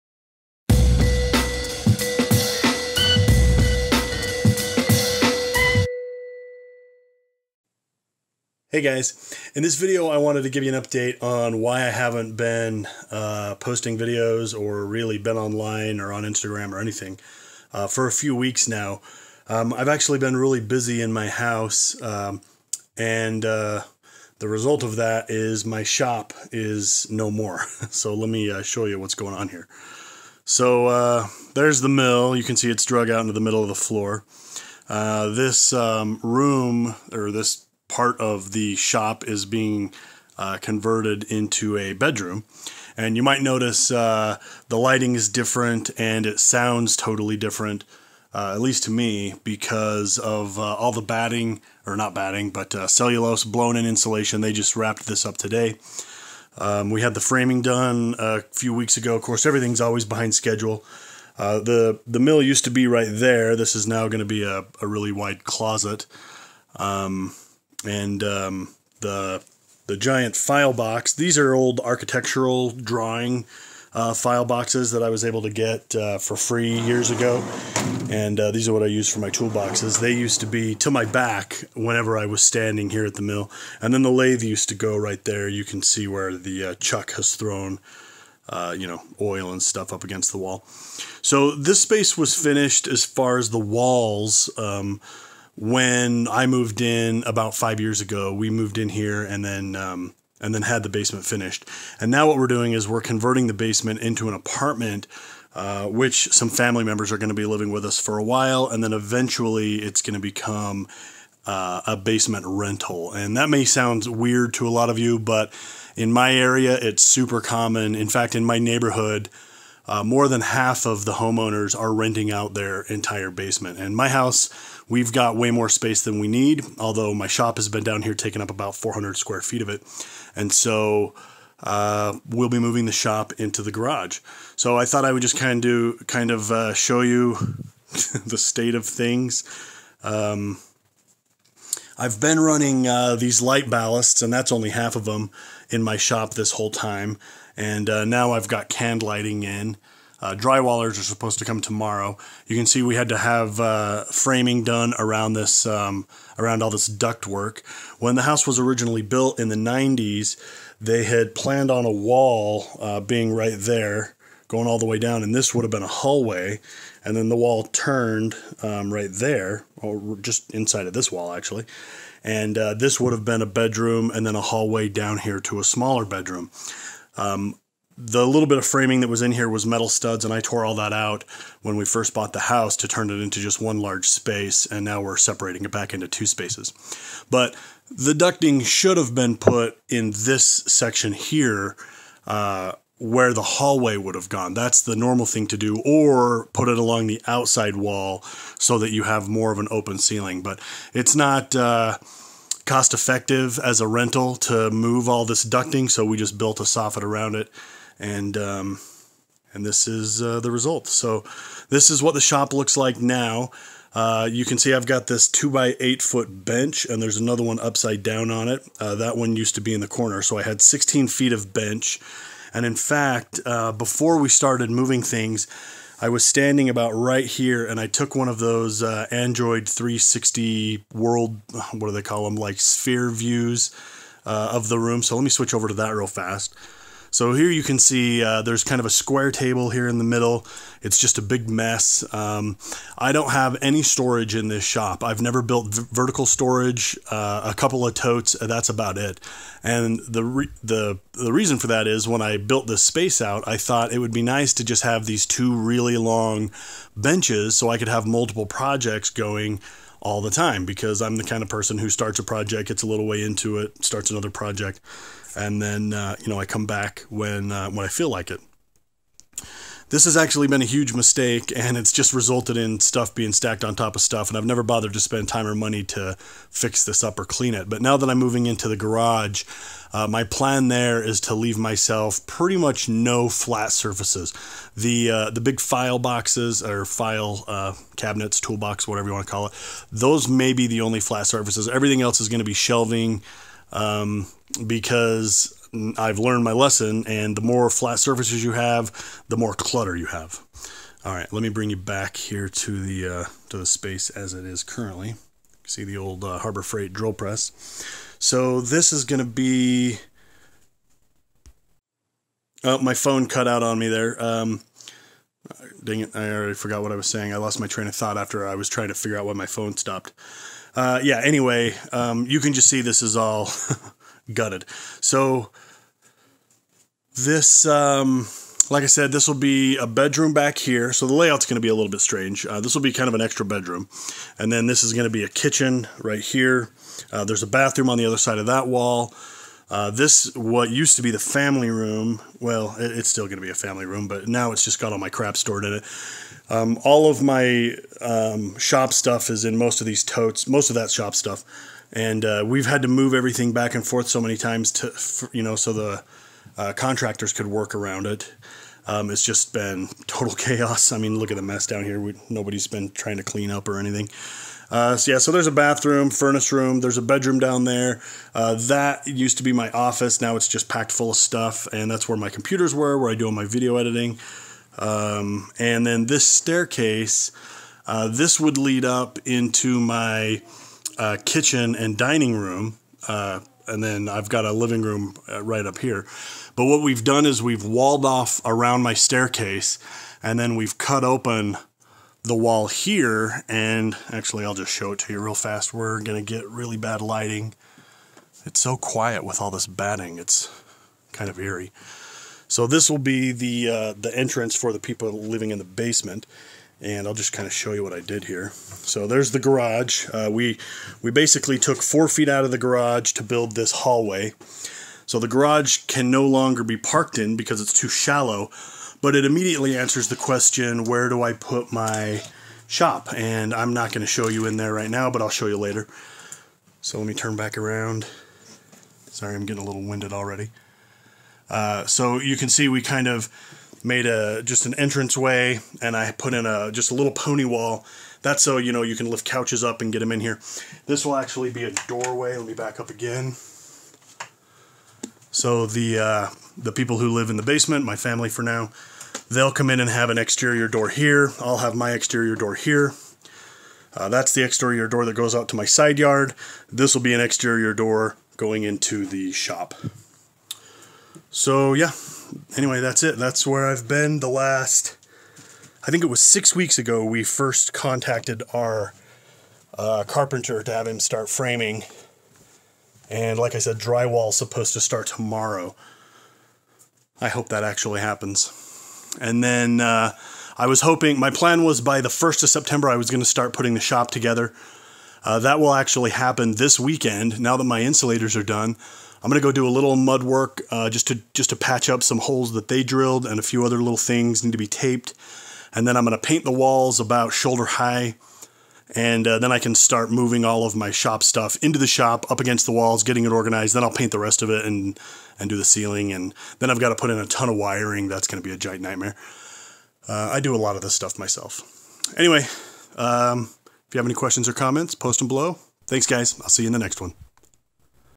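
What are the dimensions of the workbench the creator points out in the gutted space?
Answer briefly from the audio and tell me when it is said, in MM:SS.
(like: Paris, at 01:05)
2 by 8 feet, at 03:35.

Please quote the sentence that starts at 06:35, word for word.
We're going to get really bad lighting.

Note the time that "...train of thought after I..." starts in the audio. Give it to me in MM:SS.
05:17.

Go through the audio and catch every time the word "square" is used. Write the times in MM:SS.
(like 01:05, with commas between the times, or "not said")
02:09, 03:58.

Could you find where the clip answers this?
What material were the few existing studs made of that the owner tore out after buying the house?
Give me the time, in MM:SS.
02:59.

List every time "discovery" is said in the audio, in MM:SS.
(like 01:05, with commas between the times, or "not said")
not said.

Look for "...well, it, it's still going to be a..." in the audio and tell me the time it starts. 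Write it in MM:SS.
05:42.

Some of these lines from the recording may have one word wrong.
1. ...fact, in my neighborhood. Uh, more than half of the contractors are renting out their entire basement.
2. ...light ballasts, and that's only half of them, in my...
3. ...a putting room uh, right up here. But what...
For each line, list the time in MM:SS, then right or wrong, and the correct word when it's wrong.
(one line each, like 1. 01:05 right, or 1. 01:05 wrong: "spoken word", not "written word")
1. 01:58 wrong: "homeowners", not "contractors"
2. 02:23 right
3. 06:24 wrong: "living", not "putting".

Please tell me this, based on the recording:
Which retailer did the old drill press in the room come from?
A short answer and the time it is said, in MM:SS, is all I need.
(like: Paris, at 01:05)
Harbor Freight, at 05:06.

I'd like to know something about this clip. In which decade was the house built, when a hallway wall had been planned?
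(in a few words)
the 90s.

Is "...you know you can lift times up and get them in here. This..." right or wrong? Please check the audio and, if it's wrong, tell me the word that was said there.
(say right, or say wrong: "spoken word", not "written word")
wrong: "couches", not "times".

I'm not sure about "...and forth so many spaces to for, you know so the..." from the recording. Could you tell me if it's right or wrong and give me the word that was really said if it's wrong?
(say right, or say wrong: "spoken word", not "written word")
wrong: "times", not "spaces".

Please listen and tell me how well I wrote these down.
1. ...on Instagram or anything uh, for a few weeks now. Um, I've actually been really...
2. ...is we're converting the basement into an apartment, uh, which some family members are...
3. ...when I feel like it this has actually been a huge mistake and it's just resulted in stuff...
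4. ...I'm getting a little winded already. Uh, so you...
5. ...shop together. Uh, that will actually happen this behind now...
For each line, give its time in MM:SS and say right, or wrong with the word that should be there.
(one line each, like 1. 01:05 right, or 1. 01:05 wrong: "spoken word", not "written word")
1. 00:16 right
2. 01:42 right
3. 04:27 right
4. 07:09 right
5. 08:03 wrong: "weekend", not "behind".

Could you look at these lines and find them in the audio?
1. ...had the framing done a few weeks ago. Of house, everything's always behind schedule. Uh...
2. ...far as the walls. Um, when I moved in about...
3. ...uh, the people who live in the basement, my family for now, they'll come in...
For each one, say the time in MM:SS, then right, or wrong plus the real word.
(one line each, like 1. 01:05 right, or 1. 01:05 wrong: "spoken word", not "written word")
1. 00:57 wrong: "course", not "house"
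2. 01:33 right
3. 07:25 right.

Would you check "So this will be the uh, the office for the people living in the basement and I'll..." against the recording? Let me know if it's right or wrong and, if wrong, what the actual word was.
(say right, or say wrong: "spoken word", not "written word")
wrong: "entrance", not "office".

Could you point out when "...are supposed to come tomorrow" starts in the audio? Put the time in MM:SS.
02:30.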